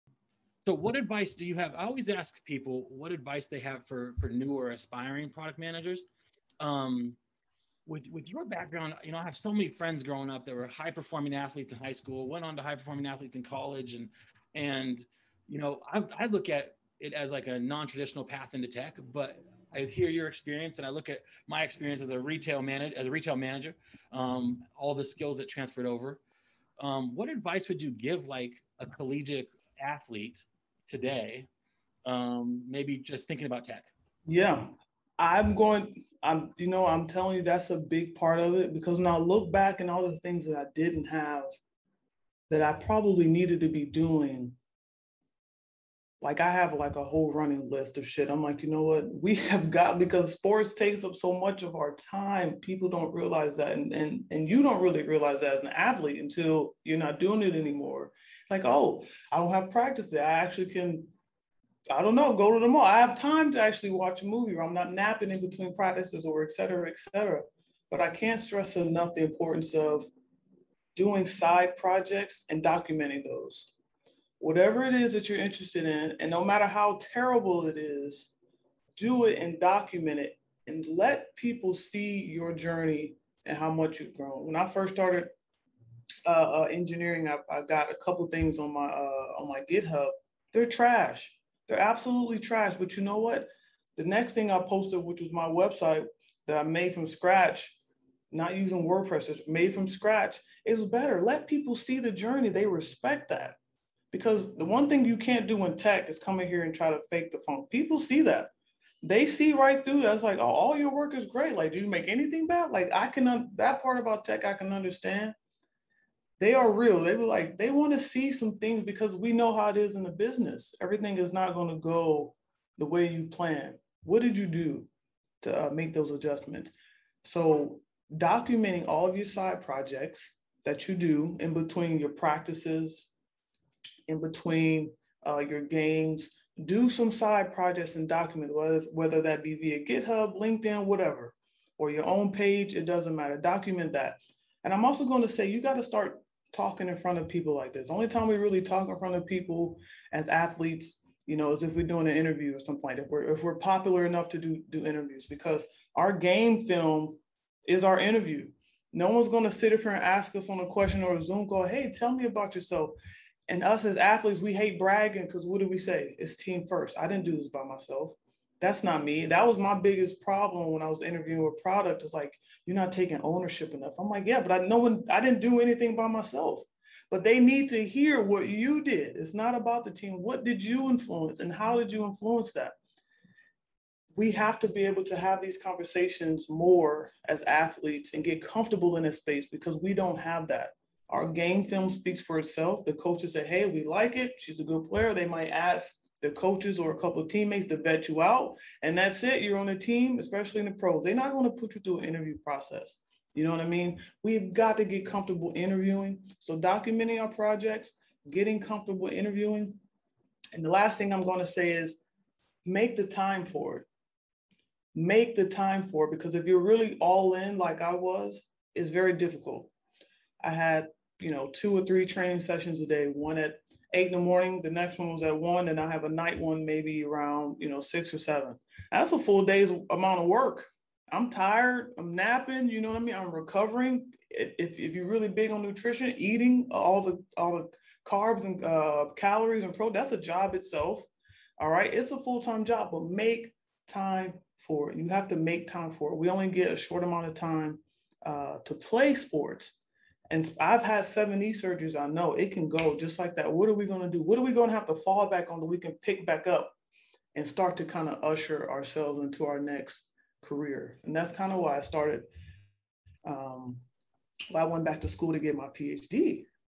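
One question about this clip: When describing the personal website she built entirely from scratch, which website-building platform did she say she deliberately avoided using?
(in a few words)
WordPress.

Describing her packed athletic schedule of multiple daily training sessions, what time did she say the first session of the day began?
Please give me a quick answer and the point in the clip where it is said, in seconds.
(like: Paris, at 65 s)
8 a.m., at 223 s.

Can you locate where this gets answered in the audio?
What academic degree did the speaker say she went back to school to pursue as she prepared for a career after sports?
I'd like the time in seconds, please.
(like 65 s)
265 s.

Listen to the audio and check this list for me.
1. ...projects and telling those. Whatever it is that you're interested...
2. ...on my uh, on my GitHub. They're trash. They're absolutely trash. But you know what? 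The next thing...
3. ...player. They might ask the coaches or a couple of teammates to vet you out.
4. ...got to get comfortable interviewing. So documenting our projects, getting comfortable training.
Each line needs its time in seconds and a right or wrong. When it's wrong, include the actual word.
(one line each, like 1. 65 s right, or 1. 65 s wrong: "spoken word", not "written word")
1. 71 s wrong: "documenting", not "telling"
2. 88 s right
3. 194 s right
4. 204 s wrong: "interviewing", not "training".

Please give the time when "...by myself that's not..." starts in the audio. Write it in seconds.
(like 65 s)
167 s.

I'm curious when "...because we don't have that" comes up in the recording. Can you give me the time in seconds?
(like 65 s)
189 s.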